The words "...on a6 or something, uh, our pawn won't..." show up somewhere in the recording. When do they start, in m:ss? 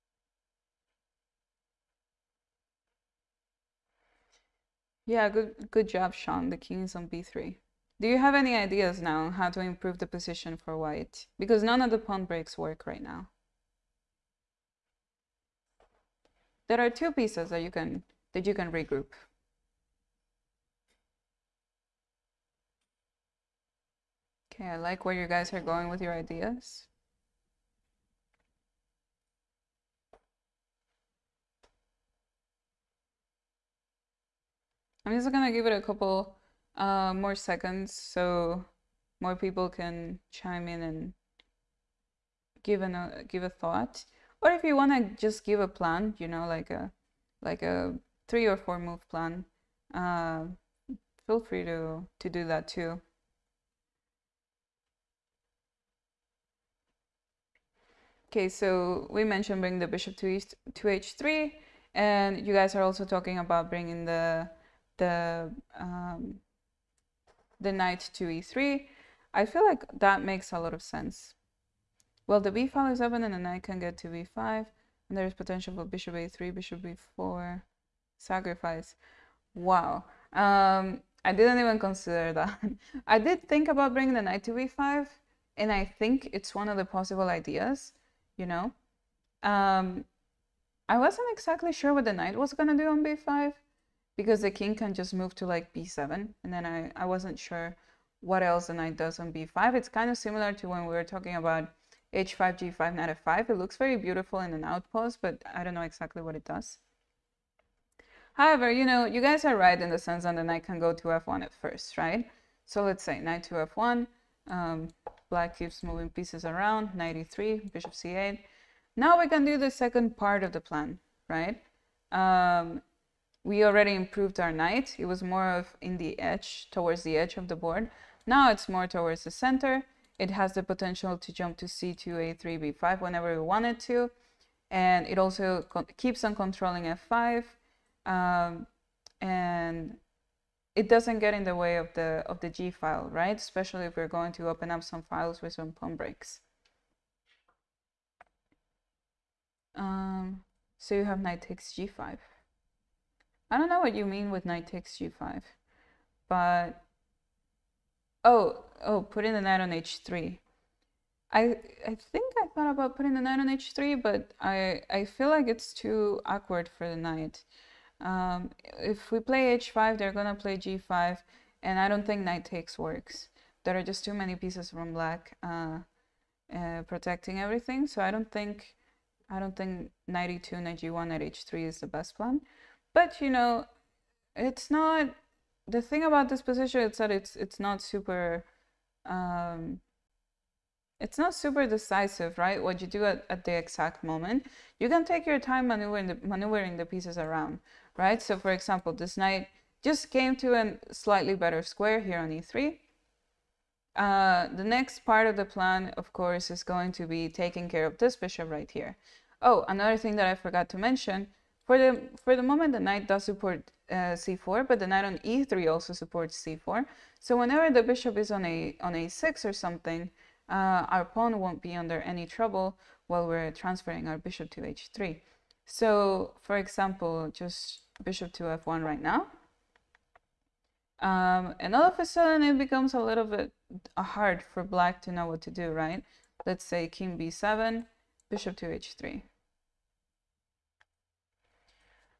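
3:38.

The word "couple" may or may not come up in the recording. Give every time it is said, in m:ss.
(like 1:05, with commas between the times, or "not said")
0:35.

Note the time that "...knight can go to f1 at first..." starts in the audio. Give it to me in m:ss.
1:50.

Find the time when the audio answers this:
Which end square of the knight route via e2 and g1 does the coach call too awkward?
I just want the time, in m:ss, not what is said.
3:01.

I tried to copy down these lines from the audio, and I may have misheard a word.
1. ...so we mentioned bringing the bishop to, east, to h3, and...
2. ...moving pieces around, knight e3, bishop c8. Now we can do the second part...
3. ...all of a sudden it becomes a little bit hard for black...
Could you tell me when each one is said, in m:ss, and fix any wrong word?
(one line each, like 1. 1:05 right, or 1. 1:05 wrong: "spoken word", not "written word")
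1. 0:58 right
2. 1:55 right
3. 3:51 right.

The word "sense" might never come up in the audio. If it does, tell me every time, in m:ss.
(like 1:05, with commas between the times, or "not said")
1:10, 1:49.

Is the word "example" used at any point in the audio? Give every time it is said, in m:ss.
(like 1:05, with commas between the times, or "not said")
3:18, 3:46.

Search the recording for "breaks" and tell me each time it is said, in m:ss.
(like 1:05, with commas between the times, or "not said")
0:12, 2:25.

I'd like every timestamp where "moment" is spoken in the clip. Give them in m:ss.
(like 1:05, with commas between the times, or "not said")
3:14, 3:32.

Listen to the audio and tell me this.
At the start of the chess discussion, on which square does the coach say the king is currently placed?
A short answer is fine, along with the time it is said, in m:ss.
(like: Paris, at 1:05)
b3, at 0:06.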